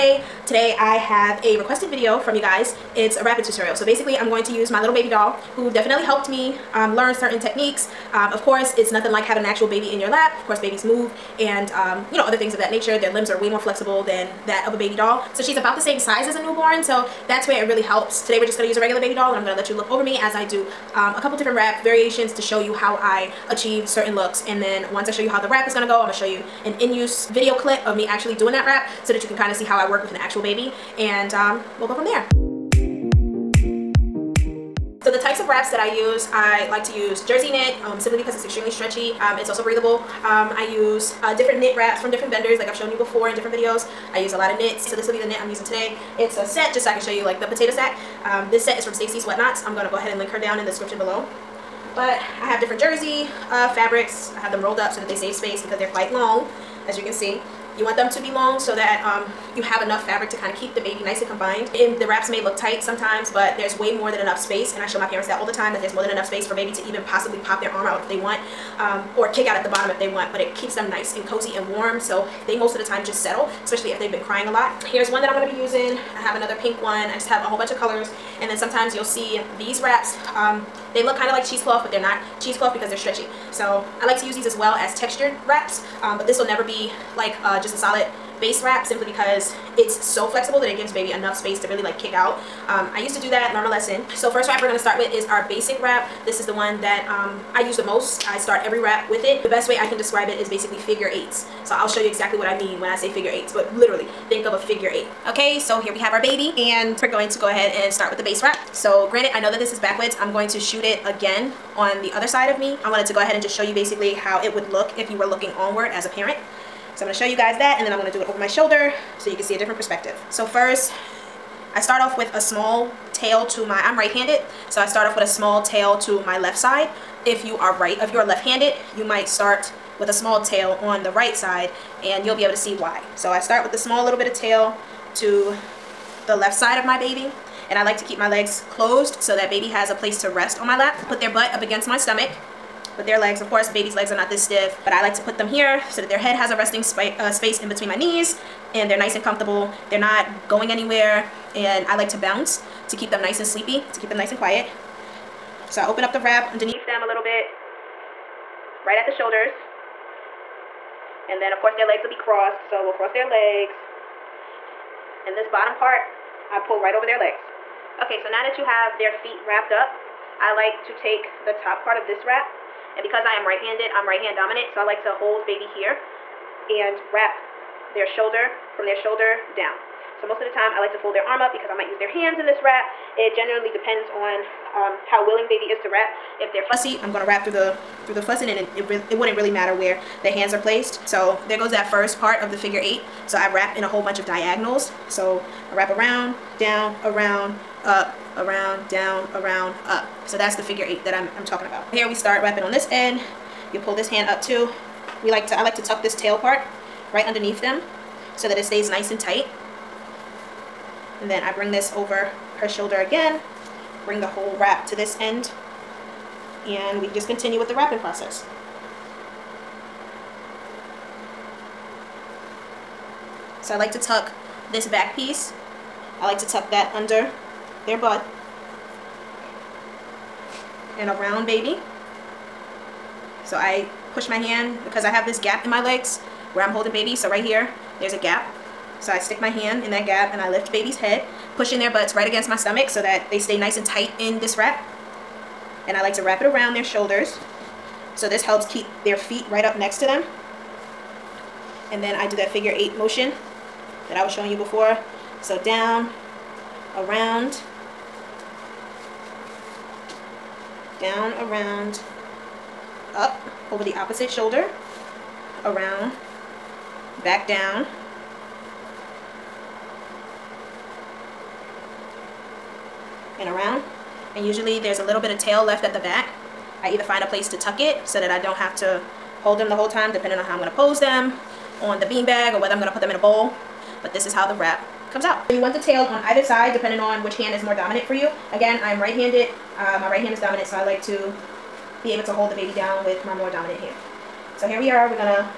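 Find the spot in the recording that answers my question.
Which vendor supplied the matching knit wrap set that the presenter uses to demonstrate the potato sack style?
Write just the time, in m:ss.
0:48.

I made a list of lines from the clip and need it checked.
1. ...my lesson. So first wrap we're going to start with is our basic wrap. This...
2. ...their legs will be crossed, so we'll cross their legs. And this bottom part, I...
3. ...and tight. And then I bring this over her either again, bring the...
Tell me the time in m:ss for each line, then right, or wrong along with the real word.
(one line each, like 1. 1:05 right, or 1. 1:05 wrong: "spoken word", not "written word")
1. 1:33 right
2. 2:41 right
3. 3:29 wrong: "shoulder", not "either".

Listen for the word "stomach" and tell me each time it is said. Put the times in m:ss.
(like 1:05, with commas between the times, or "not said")
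2:21, 4:02.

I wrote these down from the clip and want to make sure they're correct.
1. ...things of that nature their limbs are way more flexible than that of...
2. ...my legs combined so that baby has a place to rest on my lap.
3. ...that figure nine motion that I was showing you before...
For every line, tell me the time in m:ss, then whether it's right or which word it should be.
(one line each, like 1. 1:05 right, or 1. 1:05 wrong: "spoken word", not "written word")
1. 0:12 right
2. 2:18 wrong: "closed", not "combined"
3. 4:12 wrong: "eight", not "nine".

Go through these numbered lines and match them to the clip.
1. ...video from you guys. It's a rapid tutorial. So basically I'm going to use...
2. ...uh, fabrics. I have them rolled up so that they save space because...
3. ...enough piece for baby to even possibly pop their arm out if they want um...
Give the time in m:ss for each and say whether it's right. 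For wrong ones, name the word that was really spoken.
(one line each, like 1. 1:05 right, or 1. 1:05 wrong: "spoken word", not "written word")
1. 0:01 right
2. 0:53 right
3. 1:06 wrong: "space", not "piece".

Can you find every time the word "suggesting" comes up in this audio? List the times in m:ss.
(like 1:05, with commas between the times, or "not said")
not said.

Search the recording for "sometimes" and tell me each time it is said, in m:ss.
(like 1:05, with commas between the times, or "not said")
1:02, 1:18.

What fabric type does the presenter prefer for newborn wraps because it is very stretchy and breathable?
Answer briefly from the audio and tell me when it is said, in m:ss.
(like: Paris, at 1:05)
jersey knit, at 0:37.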